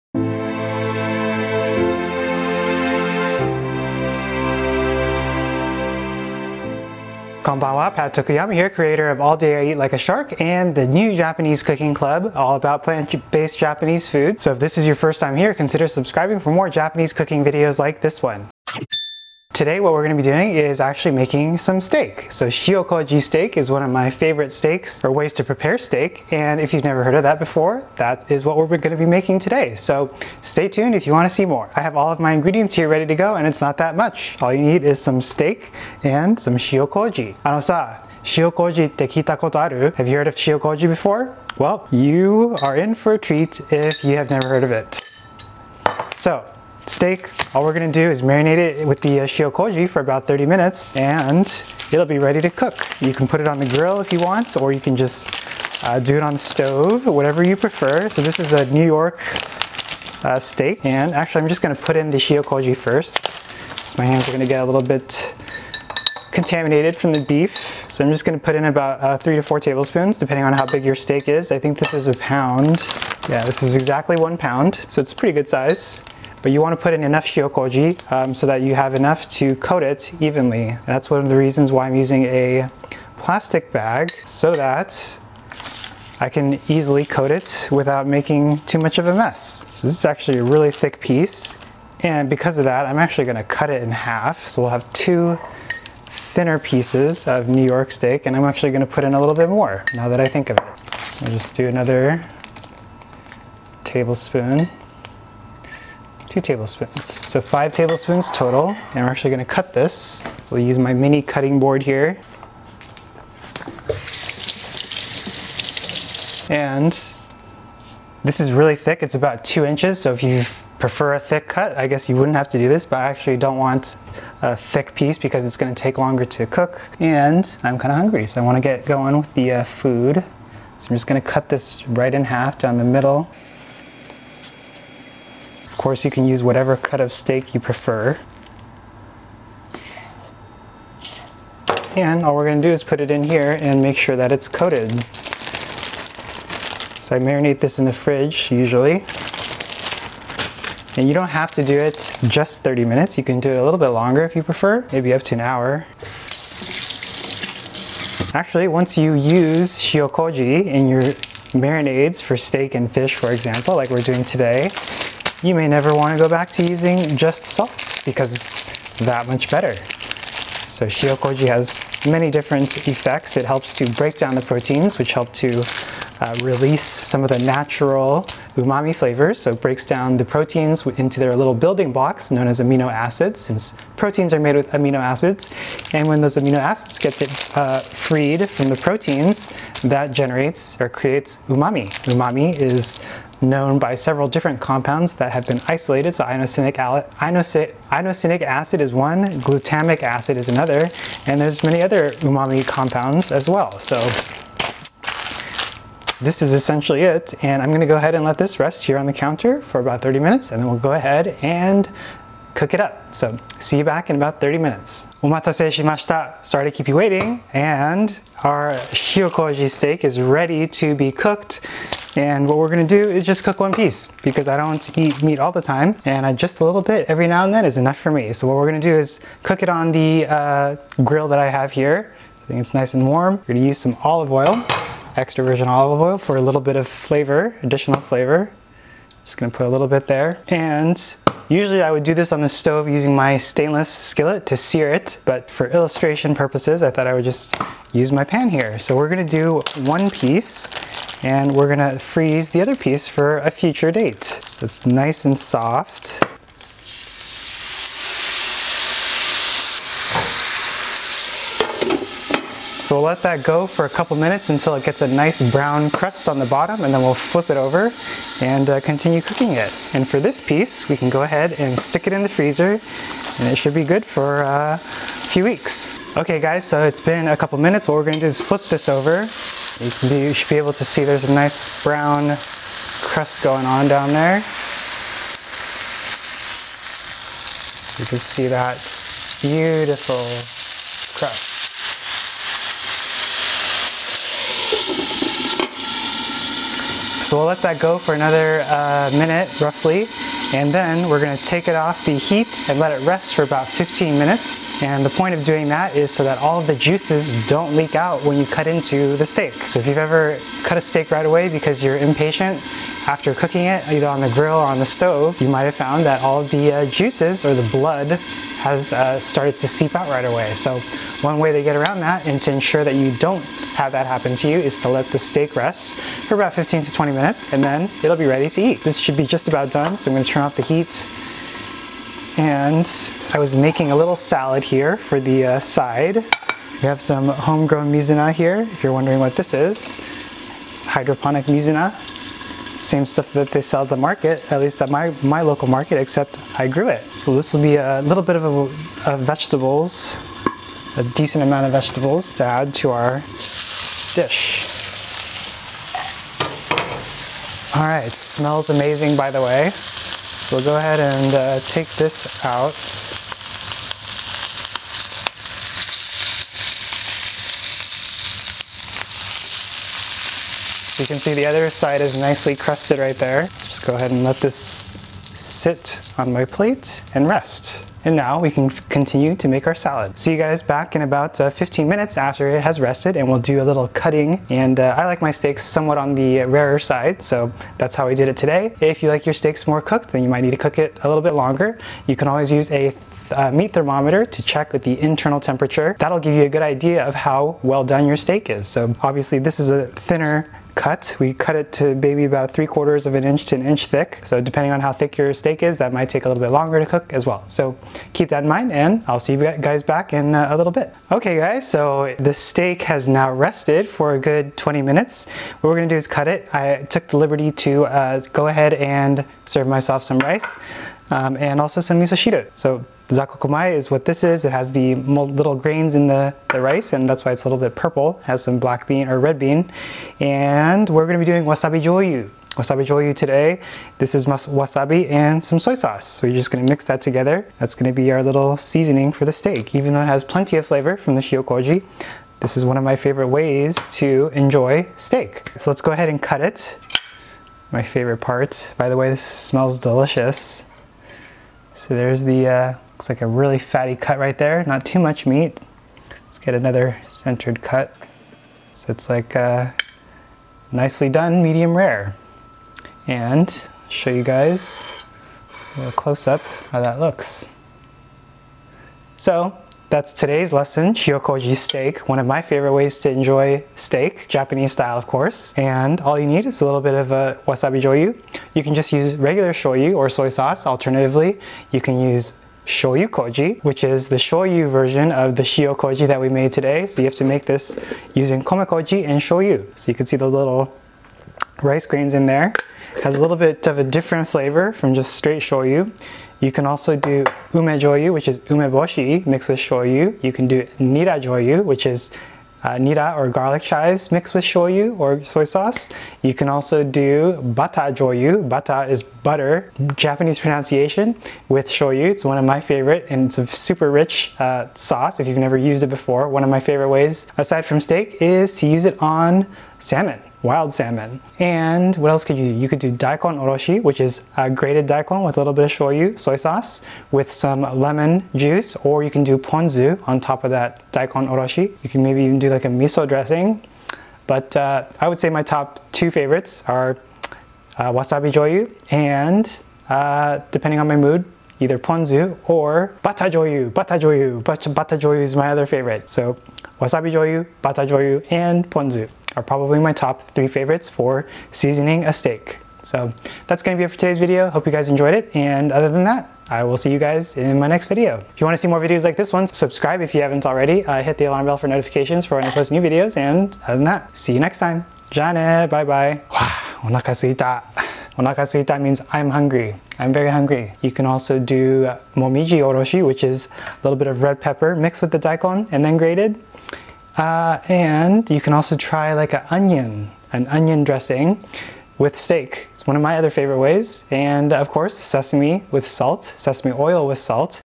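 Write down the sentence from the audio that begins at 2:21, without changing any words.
And all we're gonna do is put it in here and make sure that it's coated.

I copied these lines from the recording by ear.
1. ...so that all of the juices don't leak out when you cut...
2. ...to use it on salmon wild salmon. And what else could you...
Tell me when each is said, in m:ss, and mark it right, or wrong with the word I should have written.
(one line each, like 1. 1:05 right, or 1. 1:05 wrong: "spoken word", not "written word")
1. 5:06 right
2. 8:38 right.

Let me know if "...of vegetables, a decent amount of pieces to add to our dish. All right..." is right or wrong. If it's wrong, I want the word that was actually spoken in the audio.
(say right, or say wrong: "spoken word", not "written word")
wrong: "vegetables", not "pieces".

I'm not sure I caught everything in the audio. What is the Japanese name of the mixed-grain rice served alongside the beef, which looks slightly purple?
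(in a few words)
zakkokumai.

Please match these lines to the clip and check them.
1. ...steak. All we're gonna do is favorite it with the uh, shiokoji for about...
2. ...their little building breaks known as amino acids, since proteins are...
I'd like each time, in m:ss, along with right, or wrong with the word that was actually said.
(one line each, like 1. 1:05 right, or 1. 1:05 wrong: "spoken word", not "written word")
1. 0:46 wrong: "marinate", not "favorite"
2. 3:01 wrong: "blocks", not "breaks".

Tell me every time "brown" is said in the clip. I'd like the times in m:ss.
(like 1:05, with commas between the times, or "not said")
4:25, 4:41.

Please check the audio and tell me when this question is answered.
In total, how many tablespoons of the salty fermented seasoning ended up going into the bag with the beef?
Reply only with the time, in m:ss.
1:47.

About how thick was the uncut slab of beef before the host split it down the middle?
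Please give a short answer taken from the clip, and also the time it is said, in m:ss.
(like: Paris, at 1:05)
2 inches, at 1:59.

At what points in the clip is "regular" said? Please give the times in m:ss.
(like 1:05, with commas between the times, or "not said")
7:59.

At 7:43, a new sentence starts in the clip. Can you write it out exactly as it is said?
And show you guys a little close up how that looks.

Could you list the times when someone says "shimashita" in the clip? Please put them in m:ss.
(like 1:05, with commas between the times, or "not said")
3:35.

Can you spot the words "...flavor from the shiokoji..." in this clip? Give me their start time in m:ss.
7:20.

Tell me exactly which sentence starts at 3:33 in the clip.
So see you back in about 30 minutes.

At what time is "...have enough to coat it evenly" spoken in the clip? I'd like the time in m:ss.
1:18.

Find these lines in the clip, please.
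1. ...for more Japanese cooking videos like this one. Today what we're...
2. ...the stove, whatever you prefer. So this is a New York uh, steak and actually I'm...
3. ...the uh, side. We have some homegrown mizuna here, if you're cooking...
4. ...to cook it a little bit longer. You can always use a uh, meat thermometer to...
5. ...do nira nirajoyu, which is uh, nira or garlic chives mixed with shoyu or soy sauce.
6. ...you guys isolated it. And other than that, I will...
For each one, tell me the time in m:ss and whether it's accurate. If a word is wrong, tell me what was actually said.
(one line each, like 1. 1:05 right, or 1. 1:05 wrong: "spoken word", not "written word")
1. 0:16 right
2. 0:56 right
3. 5:35 wrong: "wondering", not "cooking"
4. 6:30 right
5. 8:20 right
6. 9:14 wrong: "enjoyed", not "isolated".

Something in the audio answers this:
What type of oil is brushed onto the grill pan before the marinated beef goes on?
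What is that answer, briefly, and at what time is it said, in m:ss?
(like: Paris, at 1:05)
extra virgin olive oil, at 3:55.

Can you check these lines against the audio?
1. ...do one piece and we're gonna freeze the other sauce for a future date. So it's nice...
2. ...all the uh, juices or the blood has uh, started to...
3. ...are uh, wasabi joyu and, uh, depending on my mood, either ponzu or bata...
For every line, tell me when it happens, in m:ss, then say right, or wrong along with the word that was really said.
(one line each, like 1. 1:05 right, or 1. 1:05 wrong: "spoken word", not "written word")
1. 4:09 wrong: "piece", not "sauce"
2. 5:16 right
3. 8:56 right.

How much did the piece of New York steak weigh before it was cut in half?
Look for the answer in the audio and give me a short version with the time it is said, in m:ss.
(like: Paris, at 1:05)
1 pound, at 1:13.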